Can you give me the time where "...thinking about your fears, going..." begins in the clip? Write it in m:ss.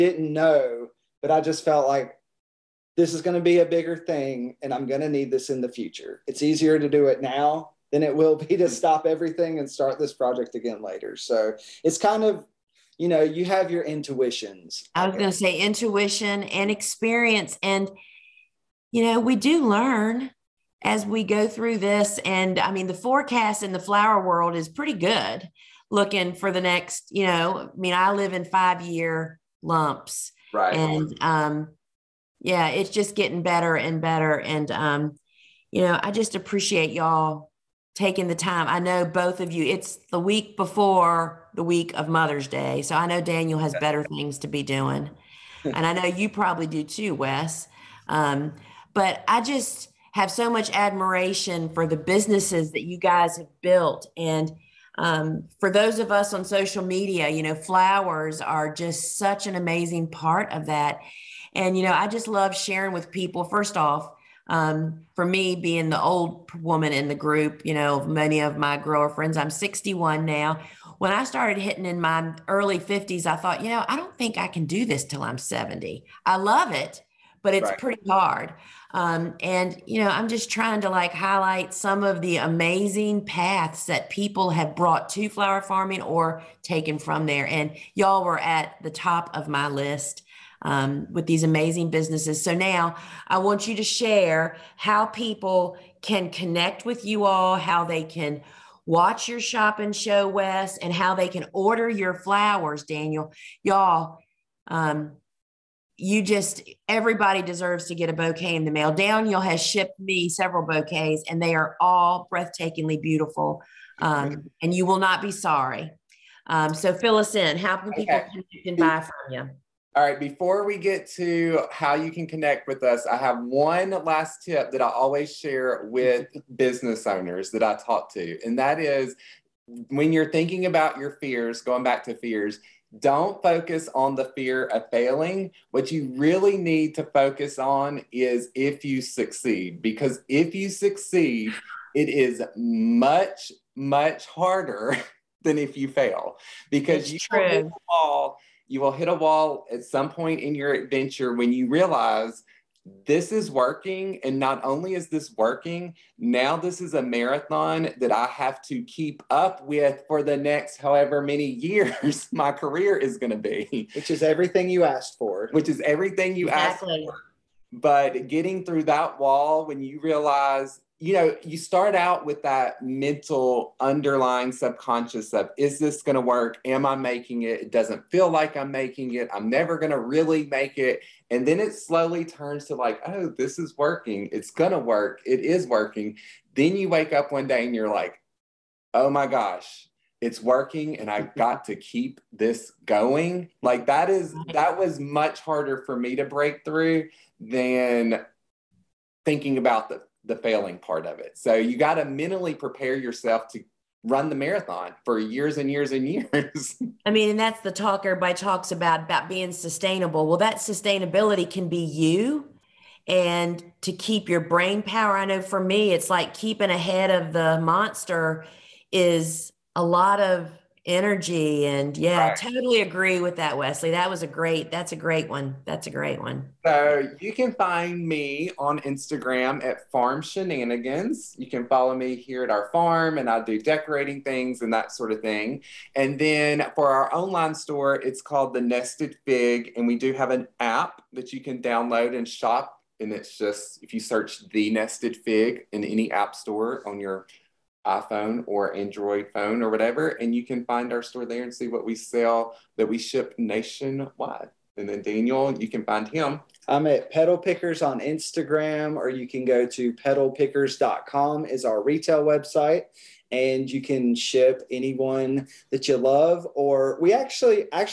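2:10.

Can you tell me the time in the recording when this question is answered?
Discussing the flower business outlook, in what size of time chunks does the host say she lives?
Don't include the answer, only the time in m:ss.
0:28.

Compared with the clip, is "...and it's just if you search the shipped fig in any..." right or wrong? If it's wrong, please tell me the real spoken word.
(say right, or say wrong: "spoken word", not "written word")
wrong: "nested", not "shipped".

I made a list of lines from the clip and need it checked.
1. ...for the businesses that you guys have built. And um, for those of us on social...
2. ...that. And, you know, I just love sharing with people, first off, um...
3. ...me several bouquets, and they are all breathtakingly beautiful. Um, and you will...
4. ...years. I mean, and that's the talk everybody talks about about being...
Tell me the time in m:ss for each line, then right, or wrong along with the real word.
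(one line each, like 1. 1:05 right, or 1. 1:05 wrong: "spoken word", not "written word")
1. 0:51 right
2. 1:00 right
3. 1:49 right
4. 3:26 right.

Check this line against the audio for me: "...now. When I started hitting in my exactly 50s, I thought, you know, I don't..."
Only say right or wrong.
wrong.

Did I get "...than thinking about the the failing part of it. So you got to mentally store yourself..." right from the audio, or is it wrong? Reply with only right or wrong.
wrong.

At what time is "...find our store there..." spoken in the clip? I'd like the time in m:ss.
4:10.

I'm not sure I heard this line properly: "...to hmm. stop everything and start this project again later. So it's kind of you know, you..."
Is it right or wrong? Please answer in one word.
right.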